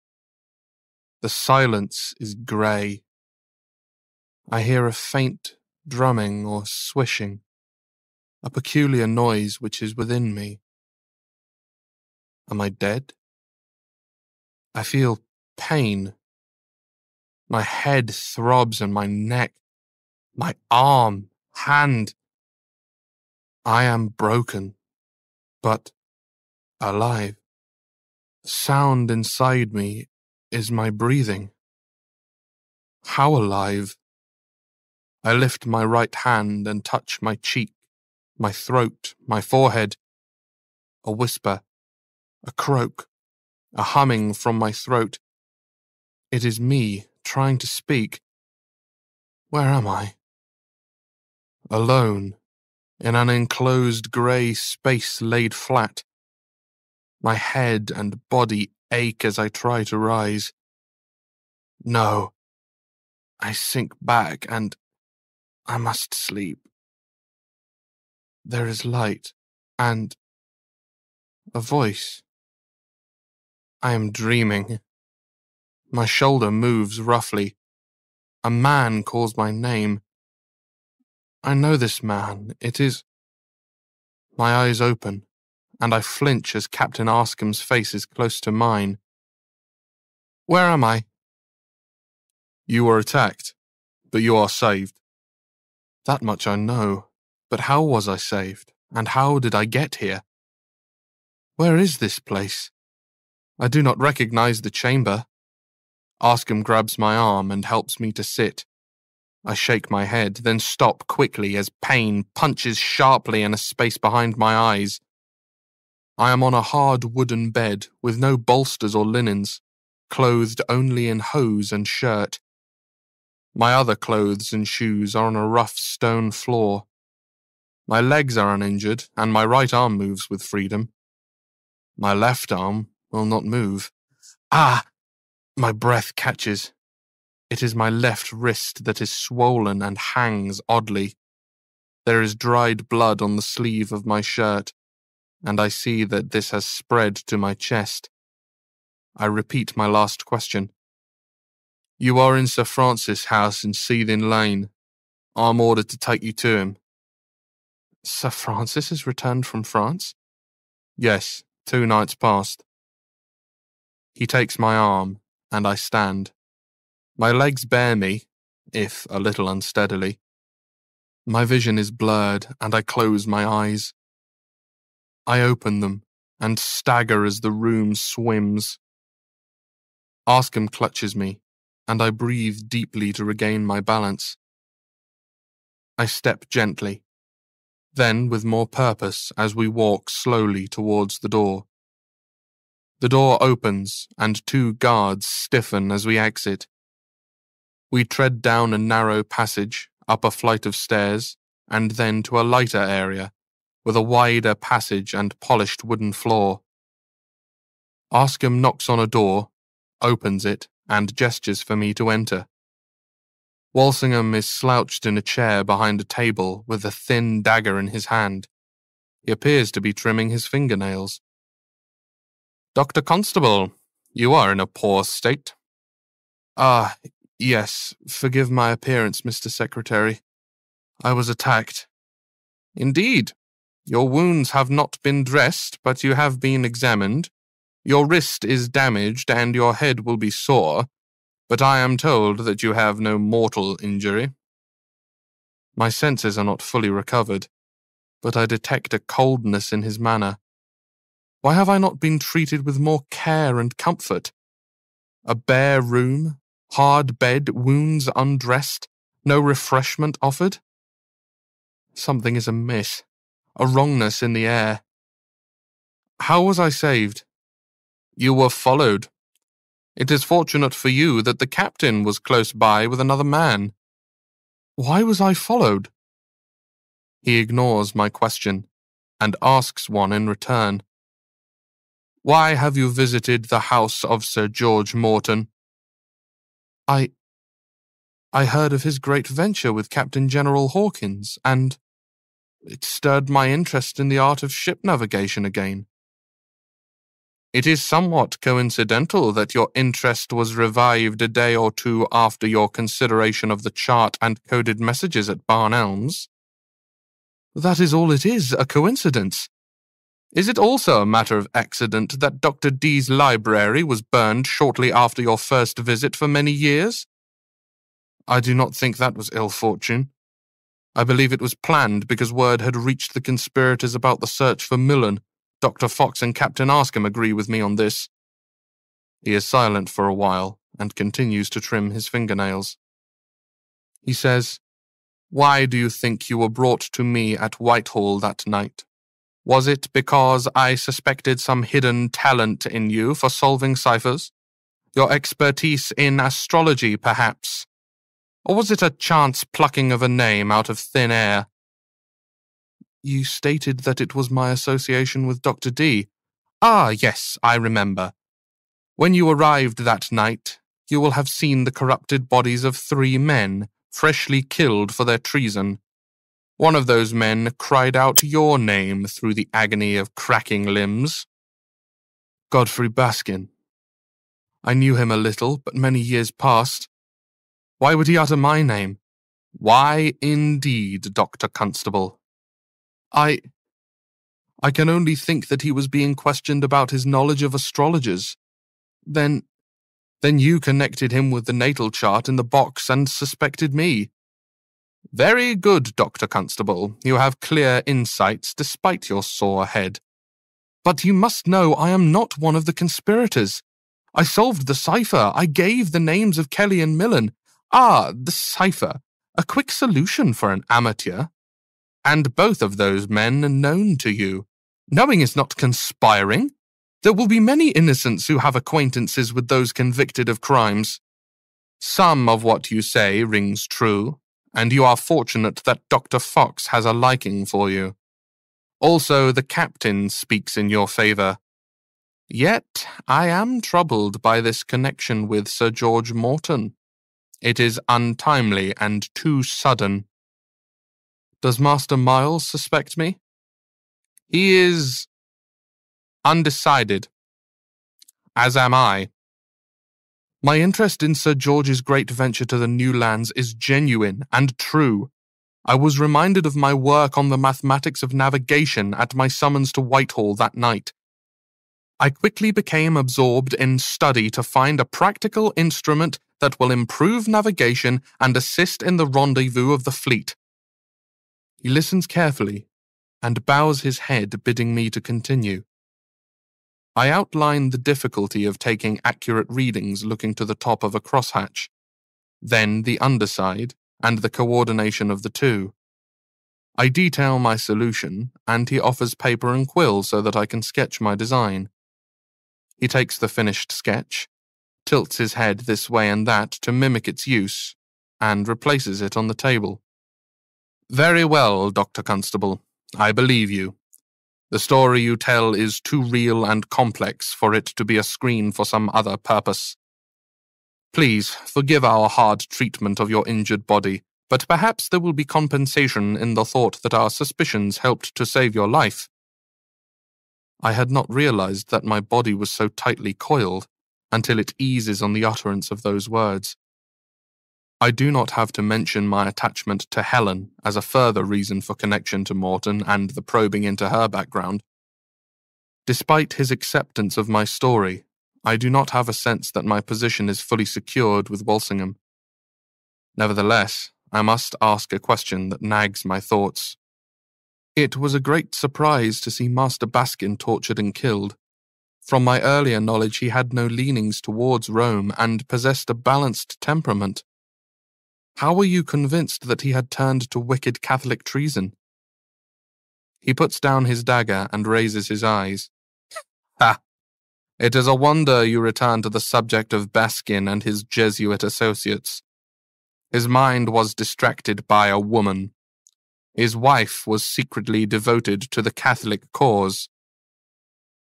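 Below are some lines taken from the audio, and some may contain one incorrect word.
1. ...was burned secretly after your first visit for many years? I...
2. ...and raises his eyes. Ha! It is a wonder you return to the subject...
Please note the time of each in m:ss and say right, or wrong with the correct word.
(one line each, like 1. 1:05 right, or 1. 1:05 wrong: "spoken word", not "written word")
1. 5:13 wrong: "shortly", not "secretly"
2. 9:24 right.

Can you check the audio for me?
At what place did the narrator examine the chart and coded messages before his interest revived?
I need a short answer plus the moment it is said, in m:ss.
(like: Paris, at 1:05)
Barn Elms, at 5:05.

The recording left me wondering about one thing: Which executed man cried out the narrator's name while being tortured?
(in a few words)
Godfrey Baskin.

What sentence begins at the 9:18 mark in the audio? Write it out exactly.
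How were you convinced that he had turned to wicked Catholic treason?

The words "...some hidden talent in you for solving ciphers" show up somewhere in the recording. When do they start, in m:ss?
5:41.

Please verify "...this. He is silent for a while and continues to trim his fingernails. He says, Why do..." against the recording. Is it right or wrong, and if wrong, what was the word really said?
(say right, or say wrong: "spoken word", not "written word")
right.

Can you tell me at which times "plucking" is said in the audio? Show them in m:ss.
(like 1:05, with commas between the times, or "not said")
5:49.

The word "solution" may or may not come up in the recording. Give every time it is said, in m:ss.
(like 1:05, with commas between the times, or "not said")
6:49, 8:07.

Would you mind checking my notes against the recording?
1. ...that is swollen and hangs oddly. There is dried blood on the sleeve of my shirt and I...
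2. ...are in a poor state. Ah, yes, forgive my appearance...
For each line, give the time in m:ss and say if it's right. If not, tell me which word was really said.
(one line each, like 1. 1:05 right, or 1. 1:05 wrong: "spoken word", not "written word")
1. 2:18 right
2. 3:44 right.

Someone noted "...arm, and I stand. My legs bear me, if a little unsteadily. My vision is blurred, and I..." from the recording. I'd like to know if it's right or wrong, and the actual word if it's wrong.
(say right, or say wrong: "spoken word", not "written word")
right.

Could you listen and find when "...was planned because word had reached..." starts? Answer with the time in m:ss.
5:21.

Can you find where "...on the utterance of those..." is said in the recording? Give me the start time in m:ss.
8:45.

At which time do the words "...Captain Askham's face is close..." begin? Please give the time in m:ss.
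1:26.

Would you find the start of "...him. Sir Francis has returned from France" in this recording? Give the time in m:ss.
2:36.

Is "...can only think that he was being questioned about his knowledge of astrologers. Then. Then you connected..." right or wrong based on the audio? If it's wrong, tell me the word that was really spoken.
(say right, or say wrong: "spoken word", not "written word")
right.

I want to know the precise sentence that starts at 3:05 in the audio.
I step gently, then with more purpose as we walk slowly towards the door.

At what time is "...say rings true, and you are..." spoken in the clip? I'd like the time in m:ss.
7:02.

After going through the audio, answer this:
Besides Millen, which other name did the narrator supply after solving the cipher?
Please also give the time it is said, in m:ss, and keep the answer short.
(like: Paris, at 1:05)
Kelly, at 6:46.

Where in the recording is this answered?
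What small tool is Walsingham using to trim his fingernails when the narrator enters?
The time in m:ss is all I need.
3:36.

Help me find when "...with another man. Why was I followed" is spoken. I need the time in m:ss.
4:32.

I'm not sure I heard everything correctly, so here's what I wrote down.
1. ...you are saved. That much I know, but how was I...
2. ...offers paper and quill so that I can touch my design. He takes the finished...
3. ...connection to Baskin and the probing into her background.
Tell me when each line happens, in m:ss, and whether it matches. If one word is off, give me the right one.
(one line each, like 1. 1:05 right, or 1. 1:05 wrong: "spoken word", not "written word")
1. 1:34 right
2. 8:08 wrong: "sketch", not "touch"
3. 8:51 wrong: "Morton", not "Baskin".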